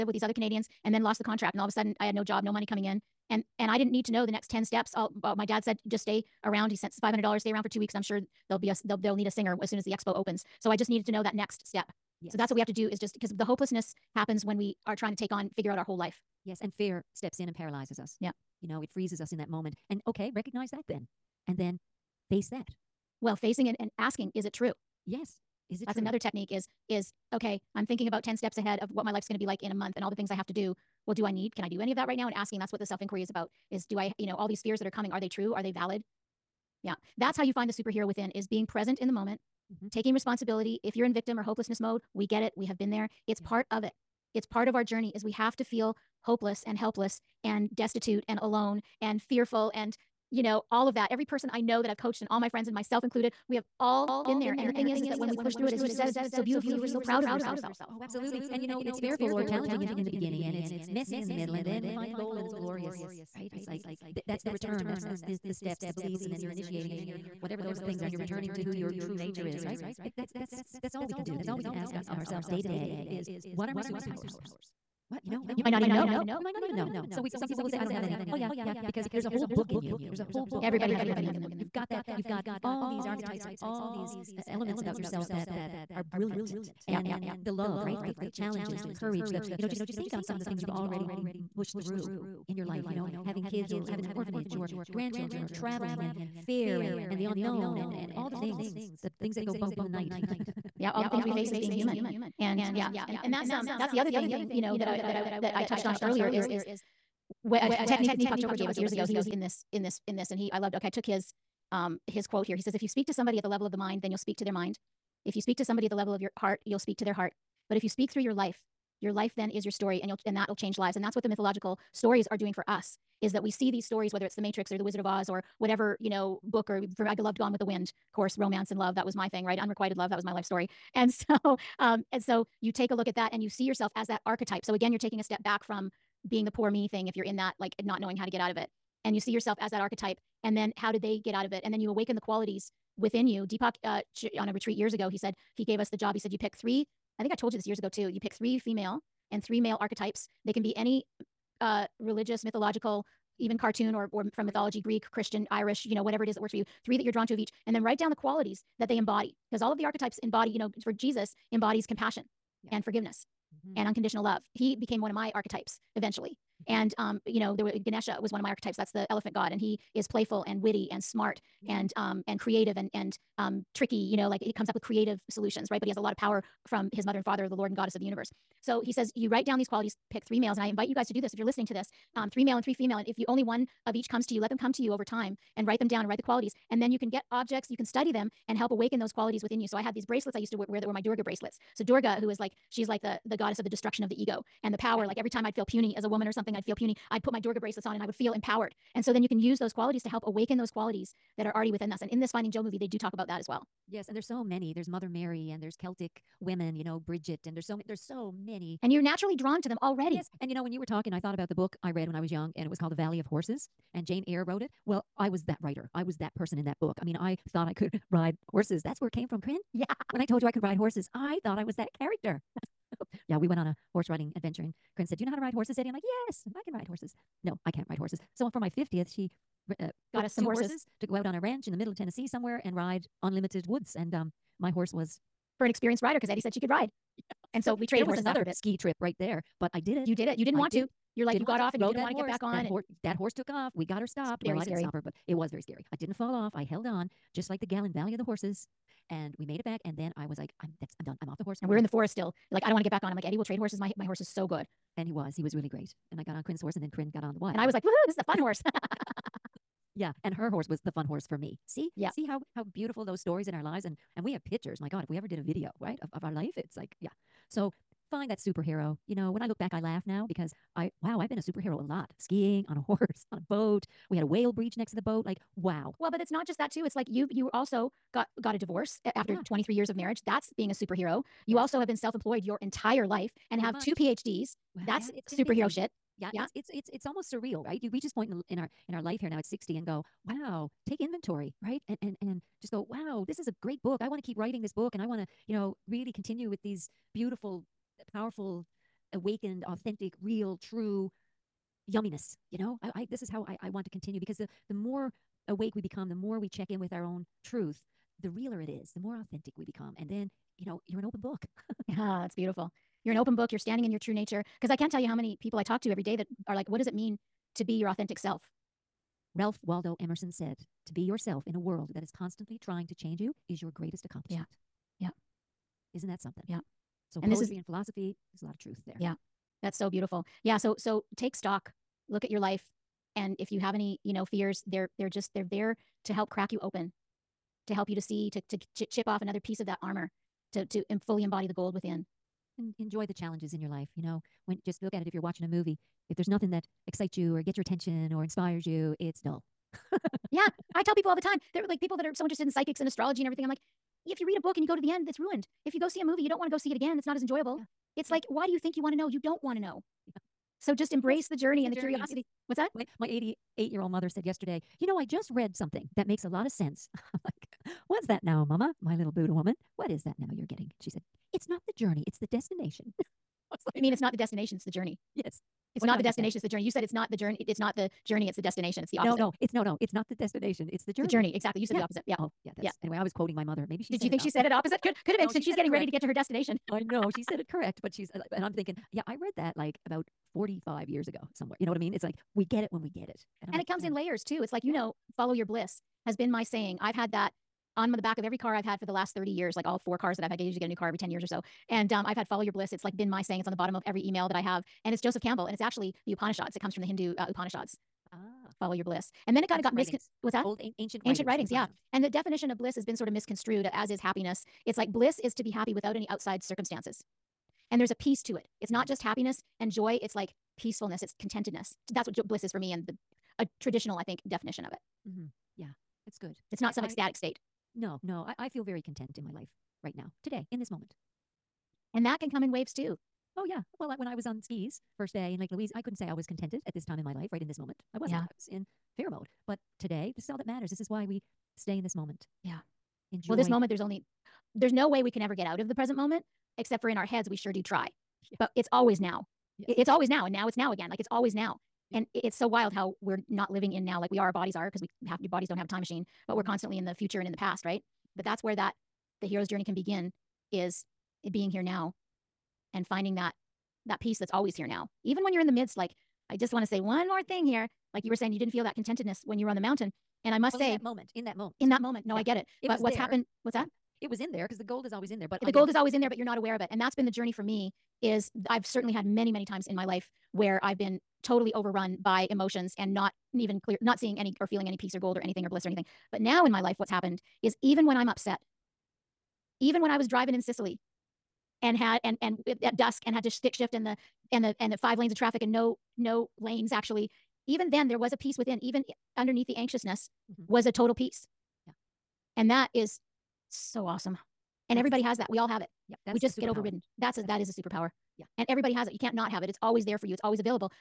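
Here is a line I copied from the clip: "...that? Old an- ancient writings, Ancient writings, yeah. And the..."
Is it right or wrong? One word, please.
right.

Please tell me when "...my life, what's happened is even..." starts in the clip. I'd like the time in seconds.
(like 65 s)
486 s.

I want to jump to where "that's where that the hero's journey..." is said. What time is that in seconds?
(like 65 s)
458 s.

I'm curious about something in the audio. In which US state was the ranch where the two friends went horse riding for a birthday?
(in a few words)
Tennessee.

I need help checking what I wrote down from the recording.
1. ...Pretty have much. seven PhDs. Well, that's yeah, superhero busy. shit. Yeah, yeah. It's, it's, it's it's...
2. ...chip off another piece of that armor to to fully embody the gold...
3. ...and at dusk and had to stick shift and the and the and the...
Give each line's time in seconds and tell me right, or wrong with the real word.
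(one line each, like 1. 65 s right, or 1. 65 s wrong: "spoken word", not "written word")
1. 283 s wrong: "two", not "seven"
2. 338 s right
3. 492 s right.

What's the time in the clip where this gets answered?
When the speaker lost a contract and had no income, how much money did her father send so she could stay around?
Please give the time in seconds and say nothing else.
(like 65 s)
7 s.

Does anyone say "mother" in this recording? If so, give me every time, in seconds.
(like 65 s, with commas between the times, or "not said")
177 s, 204 s, 363 s, 383 s.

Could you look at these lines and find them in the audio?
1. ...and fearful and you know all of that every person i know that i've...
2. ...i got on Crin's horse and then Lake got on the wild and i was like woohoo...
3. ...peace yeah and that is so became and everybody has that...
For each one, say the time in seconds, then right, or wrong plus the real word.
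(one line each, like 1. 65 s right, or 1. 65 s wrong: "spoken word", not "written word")
1. 49 s right
2. 256 s wrong: "Crin", not "Lake"
3. 500 s wrong: "awesome", not "became".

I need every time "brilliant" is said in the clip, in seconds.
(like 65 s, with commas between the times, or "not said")
86 s.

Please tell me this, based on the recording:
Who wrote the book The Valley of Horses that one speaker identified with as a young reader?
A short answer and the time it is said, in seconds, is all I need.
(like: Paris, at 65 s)
Jean Auel, at 214 s.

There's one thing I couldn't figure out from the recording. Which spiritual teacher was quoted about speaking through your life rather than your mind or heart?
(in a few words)
Deepak Chopra.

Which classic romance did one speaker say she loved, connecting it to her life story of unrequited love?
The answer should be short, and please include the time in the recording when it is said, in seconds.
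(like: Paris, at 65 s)
Gone with the Wind, at 127 s.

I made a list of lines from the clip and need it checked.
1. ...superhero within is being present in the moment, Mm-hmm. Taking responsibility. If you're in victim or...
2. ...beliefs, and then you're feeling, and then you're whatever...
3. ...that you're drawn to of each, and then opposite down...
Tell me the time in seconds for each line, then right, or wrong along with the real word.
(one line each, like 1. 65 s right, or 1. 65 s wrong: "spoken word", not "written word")
1. 37 s right
2. 65 s wrong: "initiating", not "feeling"
3. 156 s wrong: "write", not "opposite".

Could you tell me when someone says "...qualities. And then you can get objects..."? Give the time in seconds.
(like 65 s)
186 s.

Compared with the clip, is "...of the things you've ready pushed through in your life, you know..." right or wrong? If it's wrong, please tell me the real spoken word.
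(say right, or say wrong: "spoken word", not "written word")
wrong: "already", not "ready".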